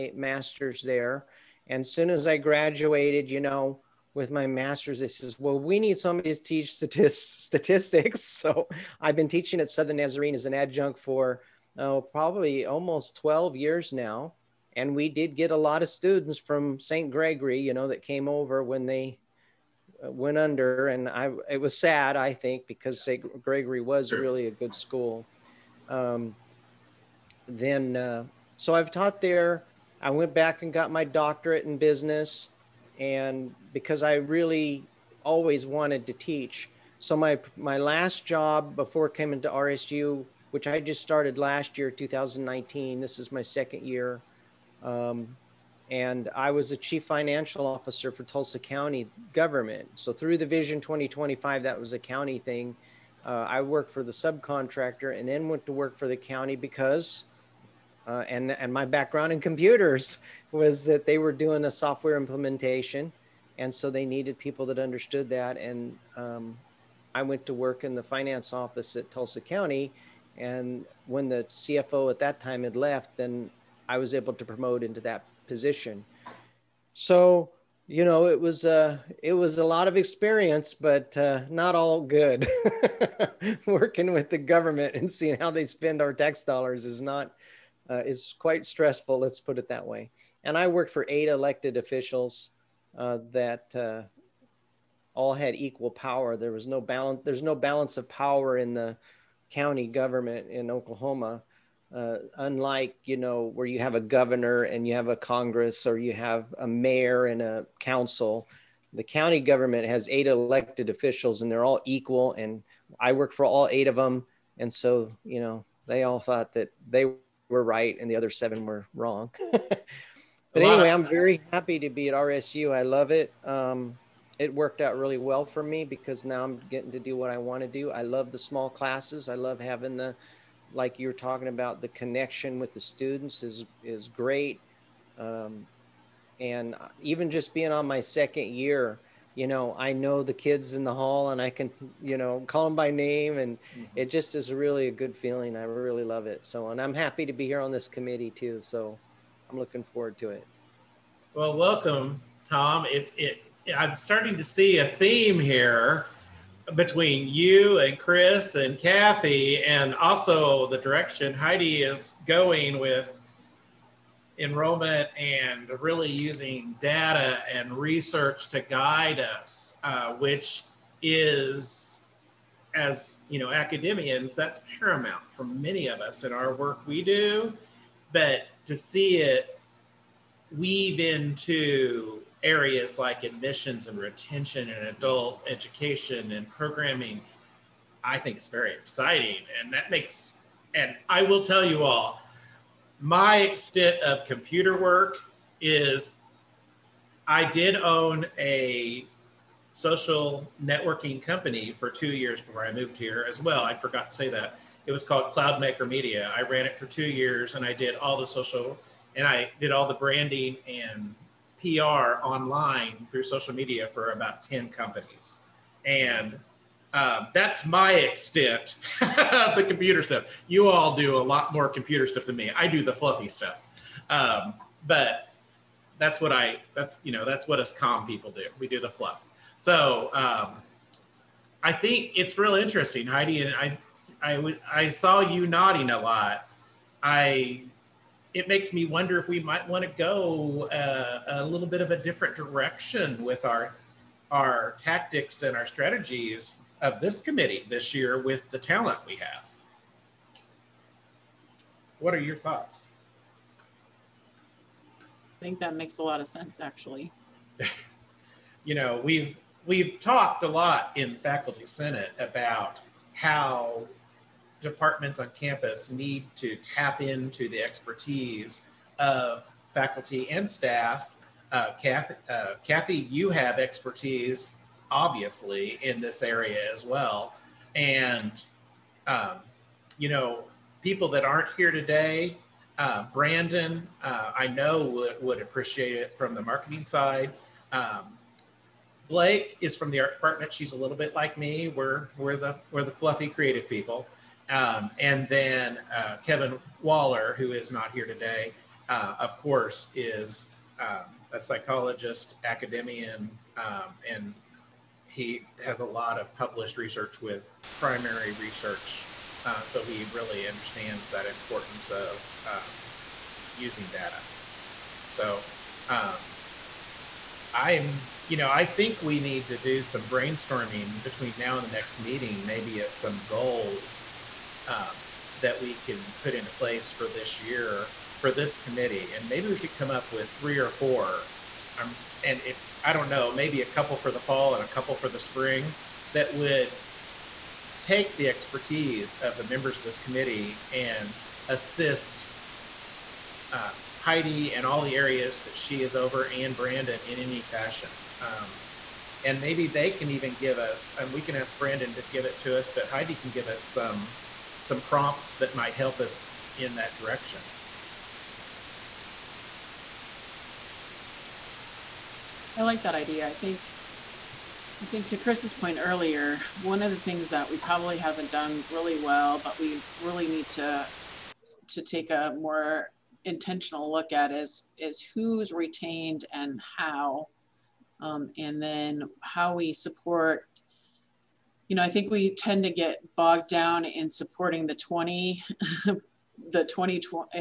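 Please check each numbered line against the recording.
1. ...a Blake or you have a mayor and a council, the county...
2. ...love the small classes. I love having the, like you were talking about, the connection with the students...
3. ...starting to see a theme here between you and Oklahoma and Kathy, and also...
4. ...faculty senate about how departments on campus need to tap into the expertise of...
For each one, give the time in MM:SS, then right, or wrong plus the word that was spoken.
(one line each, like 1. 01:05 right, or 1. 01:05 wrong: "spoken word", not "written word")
1. 01:45 wrong: "Congress", not "Blake"
2. 02:08 right
3. 02:33 wrong: "Chris", not "Oklahoma"
4. 04:21 right.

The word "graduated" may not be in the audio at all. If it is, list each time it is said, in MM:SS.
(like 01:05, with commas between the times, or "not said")
00:02.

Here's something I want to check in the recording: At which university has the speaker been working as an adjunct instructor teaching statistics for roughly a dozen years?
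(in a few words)
Southern Nazarene.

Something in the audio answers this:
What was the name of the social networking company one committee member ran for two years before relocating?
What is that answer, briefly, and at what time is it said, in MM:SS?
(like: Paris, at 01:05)
Cloud Maker Media, at 03:25.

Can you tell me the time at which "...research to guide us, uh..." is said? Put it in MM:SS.
02:47.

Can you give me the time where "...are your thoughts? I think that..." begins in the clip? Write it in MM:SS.
04:12.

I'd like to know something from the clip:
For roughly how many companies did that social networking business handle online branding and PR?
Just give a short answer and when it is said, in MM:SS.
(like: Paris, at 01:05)
10, at 03:34.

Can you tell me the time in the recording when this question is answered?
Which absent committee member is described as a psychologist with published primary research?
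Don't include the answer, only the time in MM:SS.
04:56.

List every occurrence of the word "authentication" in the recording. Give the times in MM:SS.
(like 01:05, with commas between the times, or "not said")
not said.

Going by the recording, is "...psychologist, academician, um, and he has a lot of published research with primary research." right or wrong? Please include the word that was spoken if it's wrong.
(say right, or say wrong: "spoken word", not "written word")
right.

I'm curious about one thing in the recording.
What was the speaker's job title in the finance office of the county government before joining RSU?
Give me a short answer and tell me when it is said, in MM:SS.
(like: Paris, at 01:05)
chief financial officer, at 00:46.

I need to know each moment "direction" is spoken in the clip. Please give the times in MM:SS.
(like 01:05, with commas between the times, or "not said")
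02:40, 04:02, 05:56.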